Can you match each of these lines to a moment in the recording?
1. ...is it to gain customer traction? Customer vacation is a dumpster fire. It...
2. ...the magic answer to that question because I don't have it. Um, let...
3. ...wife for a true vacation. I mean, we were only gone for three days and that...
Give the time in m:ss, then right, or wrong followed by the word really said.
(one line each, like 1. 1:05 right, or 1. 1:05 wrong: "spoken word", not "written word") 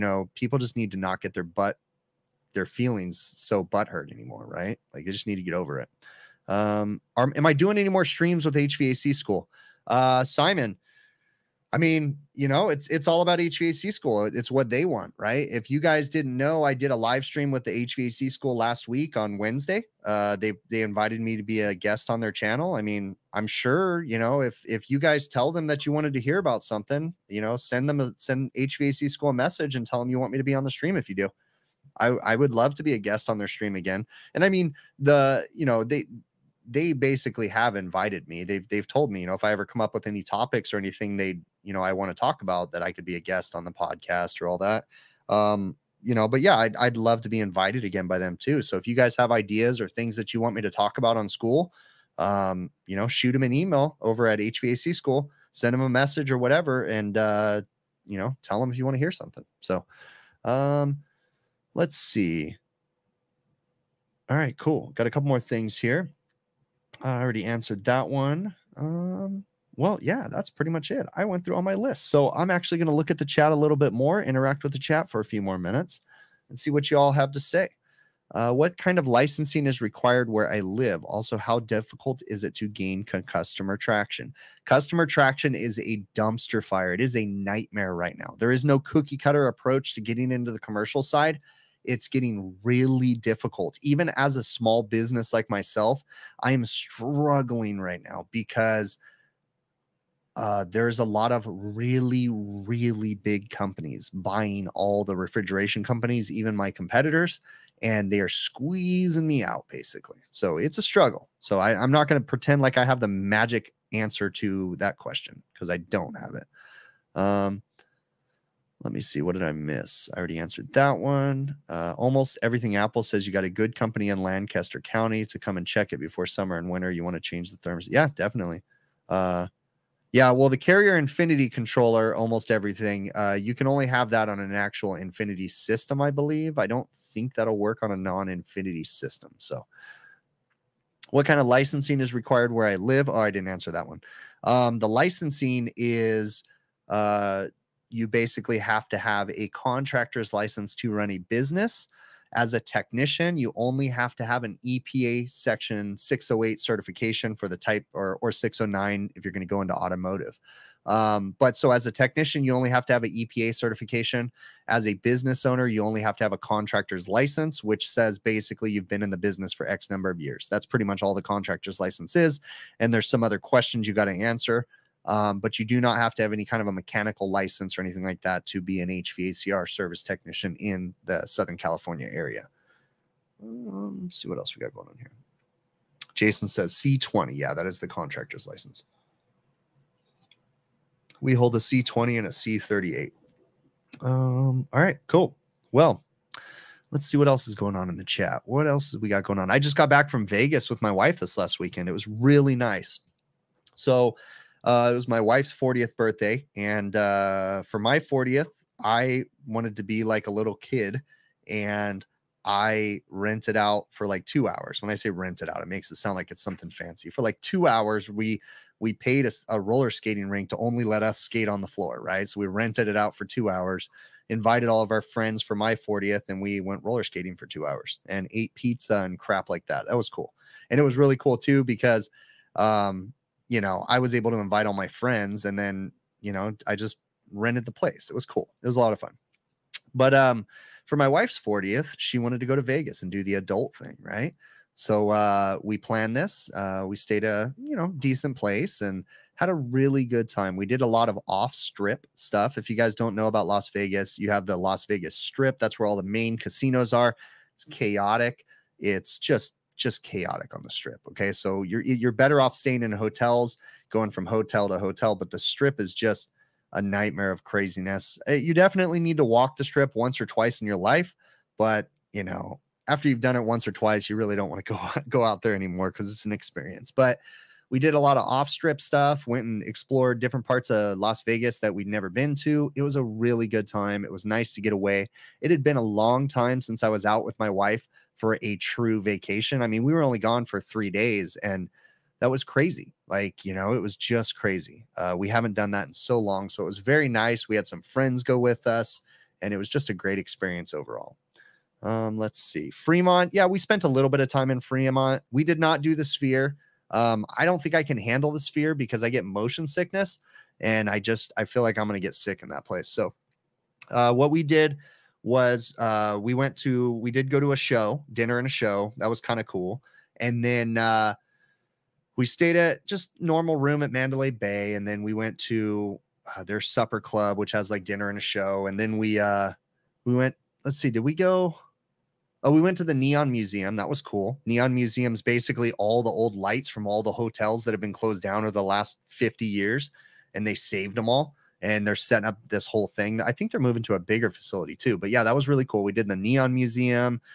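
1. 1:22 wrong: "traction", not "vacation"
2. 1:52 right
3. 4:47 right.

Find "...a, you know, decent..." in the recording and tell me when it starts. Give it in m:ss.
4:07.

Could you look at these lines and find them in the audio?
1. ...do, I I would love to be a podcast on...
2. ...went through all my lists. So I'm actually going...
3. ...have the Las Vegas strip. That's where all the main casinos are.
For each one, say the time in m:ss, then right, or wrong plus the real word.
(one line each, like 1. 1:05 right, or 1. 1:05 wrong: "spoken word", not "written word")
1. 0:31 wrong: "guest", not "podcast"
2. 1:11 right
3. 4:14 right.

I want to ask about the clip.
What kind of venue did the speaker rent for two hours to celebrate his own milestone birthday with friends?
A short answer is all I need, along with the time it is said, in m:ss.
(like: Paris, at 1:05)
Roller skating rink, at 3:39.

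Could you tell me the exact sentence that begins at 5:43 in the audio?
I think they're moving to a bigger facility too.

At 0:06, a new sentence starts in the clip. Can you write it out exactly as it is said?
Um, are, am I doing any more streams with HVAC school?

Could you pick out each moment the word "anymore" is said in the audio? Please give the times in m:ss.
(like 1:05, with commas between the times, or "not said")
0:04, 4:35.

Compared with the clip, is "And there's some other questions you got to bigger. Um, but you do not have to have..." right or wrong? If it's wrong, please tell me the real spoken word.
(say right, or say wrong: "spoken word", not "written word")
wrong: "answer", not "bigger".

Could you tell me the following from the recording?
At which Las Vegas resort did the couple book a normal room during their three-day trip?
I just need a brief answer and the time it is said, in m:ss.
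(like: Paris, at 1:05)
Mandalay Bay, at 5:23.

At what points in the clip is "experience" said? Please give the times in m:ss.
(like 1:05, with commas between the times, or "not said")
4:36, 5:00.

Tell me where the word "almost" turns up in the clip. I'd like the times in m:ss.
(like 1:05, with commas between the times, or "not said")
2:01, 2:12.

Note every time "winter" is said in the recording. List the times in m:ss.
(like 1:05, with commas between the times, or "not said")
2:06.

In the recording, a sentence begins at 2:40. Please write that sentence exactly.
Um, but so as a technician, you only have to have an EPA certification.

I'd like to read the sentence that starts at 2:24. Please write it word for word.
Um, the licensing is uh, you basically have to have a contractor's license to run a business.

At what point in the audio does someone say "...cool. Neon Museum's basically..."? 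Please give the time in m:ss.
5:34.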